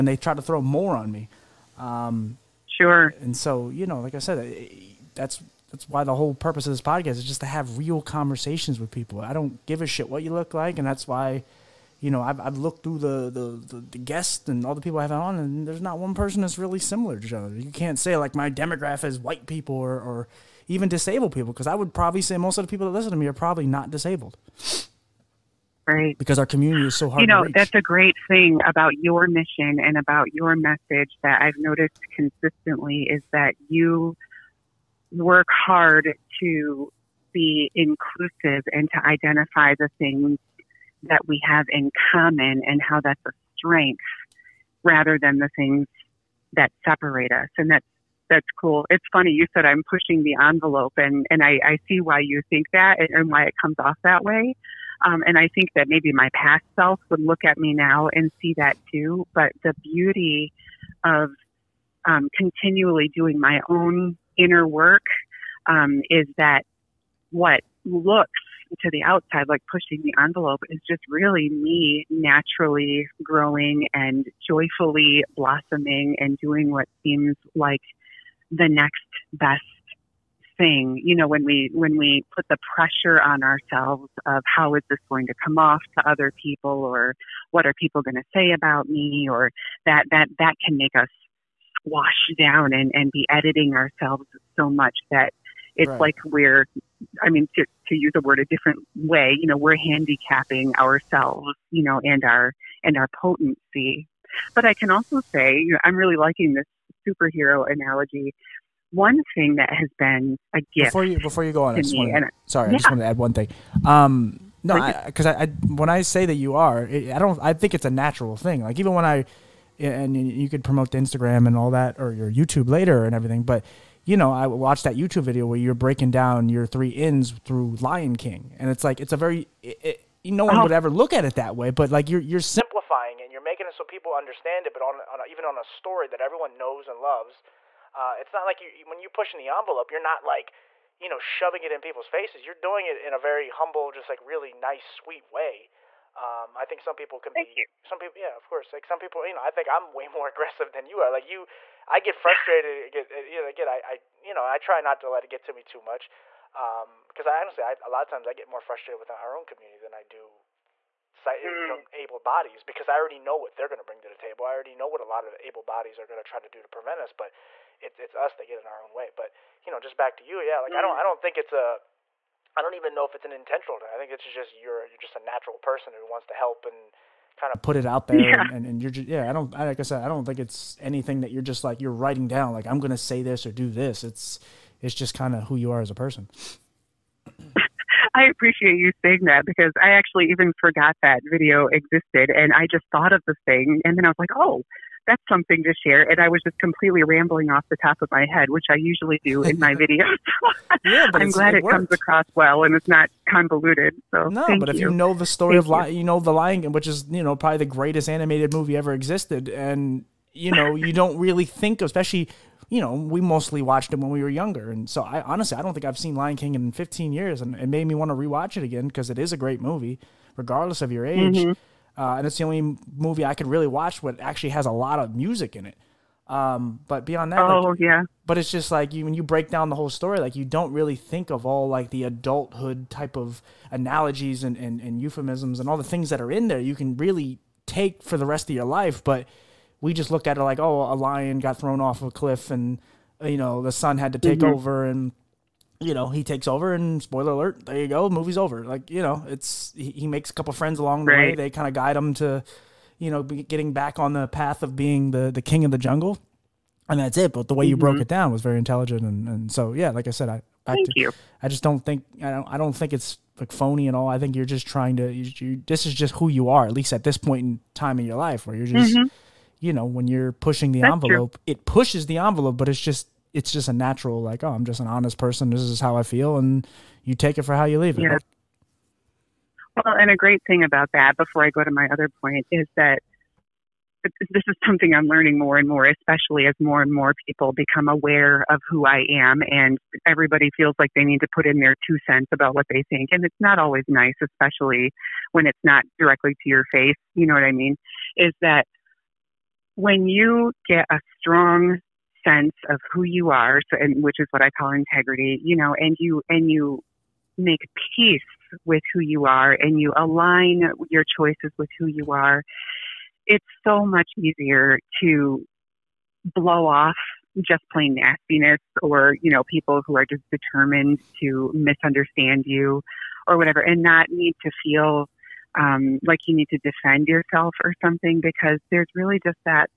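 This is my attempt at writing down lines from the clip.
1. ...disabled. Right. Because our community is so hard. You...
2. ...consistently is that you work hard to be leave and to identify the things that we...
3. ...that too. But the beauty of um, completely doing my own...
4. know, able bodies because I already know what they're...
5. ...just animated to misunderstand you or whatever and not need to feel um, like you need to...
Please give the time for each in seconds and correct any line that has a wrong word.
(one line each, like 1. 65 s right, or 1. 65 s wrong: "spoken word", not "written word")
1. 23 s right
2. 32 s wrong: "inclusive", not "leave"
3. 58 s wrong: "continually", not "completely"
4. 161 s right
5. 320 s wrong: "determined", not "animated".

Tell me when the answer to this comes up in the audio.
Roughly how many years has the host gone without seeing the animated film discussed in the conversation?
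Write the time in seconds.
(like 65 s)
216 s.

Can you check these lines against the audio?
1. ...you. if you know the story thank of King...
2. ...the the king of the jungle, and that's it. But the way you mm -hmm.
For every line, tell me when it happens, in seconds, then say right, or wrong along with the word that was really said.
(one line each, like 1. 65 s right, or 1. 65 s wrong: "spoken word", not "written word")
1. 204 s wrong: "Lion", not "King"
2. 255 s right.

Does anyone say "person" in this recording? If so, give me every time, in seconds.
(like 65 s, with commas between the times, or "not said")
16 s, 175 s, 185 s, 275 s.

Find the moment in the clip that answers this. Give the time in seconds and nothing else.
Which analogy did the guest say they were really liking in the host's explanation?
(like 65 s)
107 s.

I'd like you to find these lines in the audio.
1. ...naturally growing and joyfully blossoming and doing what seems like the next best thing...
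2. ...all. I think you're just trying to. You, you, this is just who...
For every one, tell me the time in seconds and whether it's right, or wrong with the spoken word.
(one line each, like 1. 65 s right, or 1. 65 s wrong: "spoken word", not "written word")
1. 72 s right
2. 263 s right.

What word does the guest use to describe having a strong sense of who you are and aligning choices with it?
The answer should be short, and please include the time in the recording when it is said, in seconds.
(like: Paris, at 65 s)
Integrity, at 304 s.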